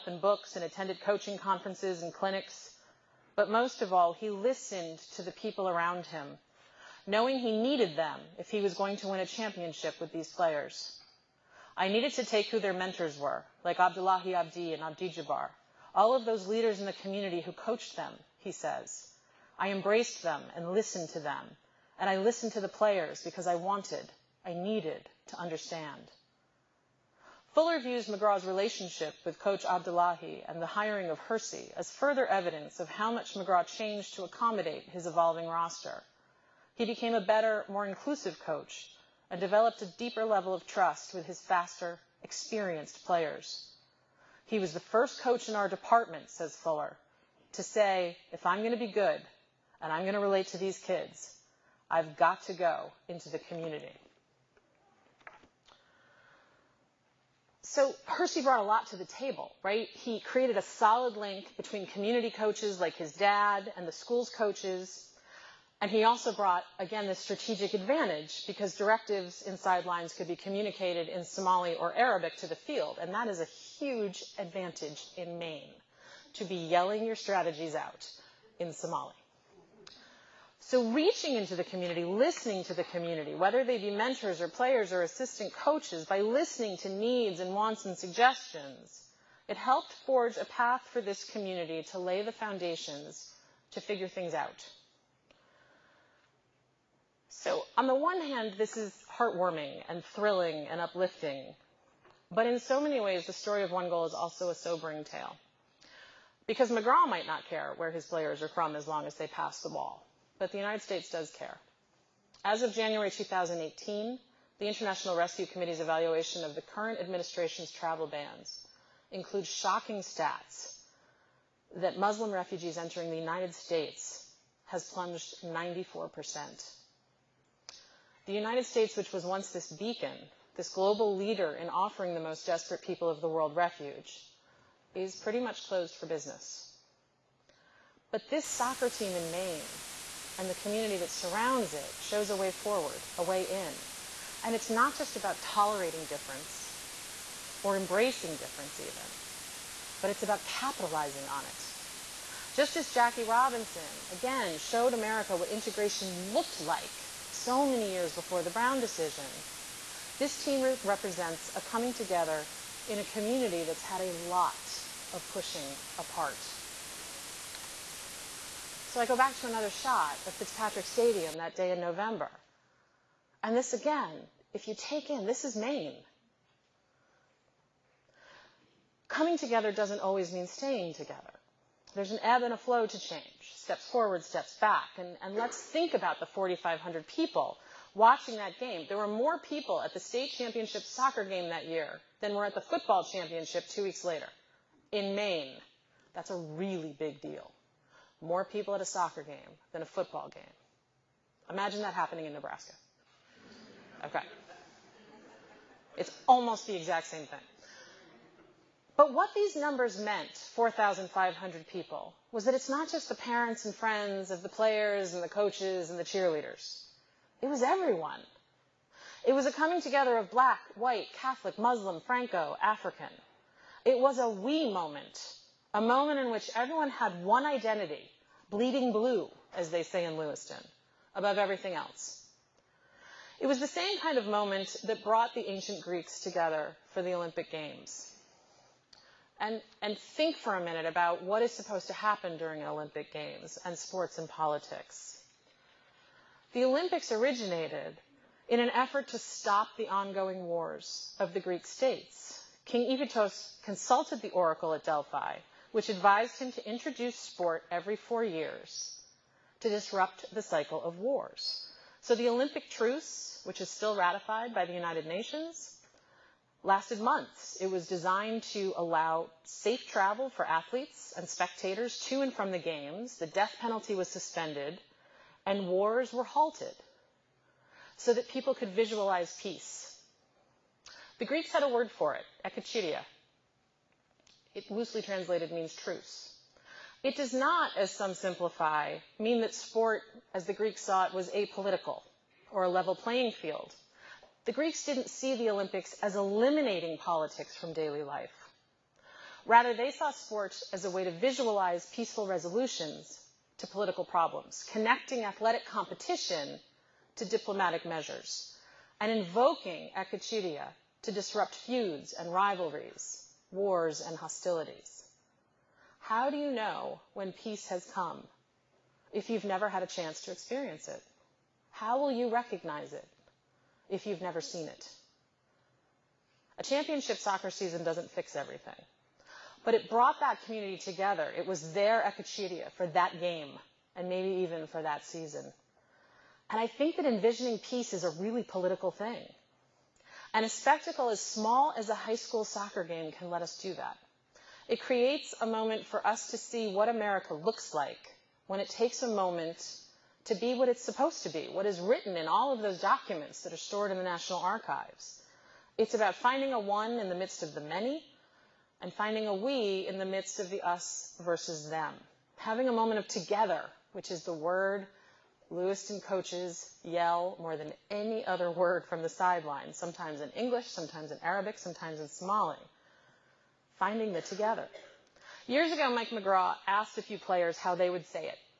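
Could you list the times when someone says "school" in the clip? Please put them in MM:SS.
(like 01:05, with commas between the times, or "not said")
01:03, 05:42.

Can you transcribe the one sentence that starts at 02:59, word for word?
Coming together doesn't always mean staying together.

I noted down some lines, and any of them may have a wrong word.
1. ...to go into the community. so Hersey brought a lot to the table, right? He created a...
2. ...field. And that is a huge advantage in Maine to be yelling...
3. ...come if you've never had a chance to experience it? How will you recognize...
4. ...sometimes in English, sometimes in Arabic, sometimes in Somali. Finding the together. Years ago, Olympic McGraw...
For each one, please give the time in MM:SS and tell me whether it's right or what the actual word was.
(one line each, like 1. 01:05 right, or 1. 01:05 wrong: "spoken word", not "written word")
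1. 00:52 right
2. 01:12 right
3. 05:17 right
4. 06:09 wrong: "Mike", not "Olympic".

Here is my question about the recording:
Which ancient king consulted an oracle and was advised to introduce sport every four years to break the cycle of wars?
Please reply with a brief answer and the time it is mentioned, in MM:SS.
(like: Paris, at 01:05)
King Iphitos, at 04:12.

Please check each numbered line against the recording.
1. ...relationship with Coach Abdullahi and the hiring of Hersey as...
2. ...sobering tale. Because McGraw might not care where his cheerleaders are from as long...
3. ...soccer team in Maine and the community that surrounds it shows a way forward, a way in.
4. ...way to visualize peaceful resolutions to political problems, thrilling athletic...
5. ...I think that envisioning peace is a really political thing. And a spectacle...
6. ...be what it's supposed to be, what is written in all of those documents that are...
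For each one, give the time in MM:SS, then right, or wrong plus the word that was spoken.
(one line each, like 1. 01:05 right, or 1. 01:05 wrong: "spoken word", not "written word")
1. 00:28 right
2. 01:44 wrong: "players", not "cheerleaders"
3. 02:18 right
4. 05:00 wrong: "connecting", not "thrilling"
5. 05:36 right
6. 05:50 right.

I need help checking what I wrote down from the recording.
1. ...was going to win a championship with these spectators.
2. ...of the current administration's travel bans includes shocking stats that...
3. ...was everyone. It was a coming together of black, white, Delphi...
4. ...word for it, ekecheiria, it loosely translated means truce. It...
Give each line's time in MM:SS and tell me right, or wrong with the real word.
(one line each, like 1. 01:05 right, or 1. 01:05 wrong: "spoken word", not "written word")
1. 00:08 wrong: "players", not "spectators"
2. 01:56 right
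3. 03:37 wrong: "Catholic", not "Delphi"
4. 04:41 right.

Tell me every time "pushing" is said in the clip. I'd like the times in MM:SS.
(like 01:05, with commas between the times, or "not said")
02:45.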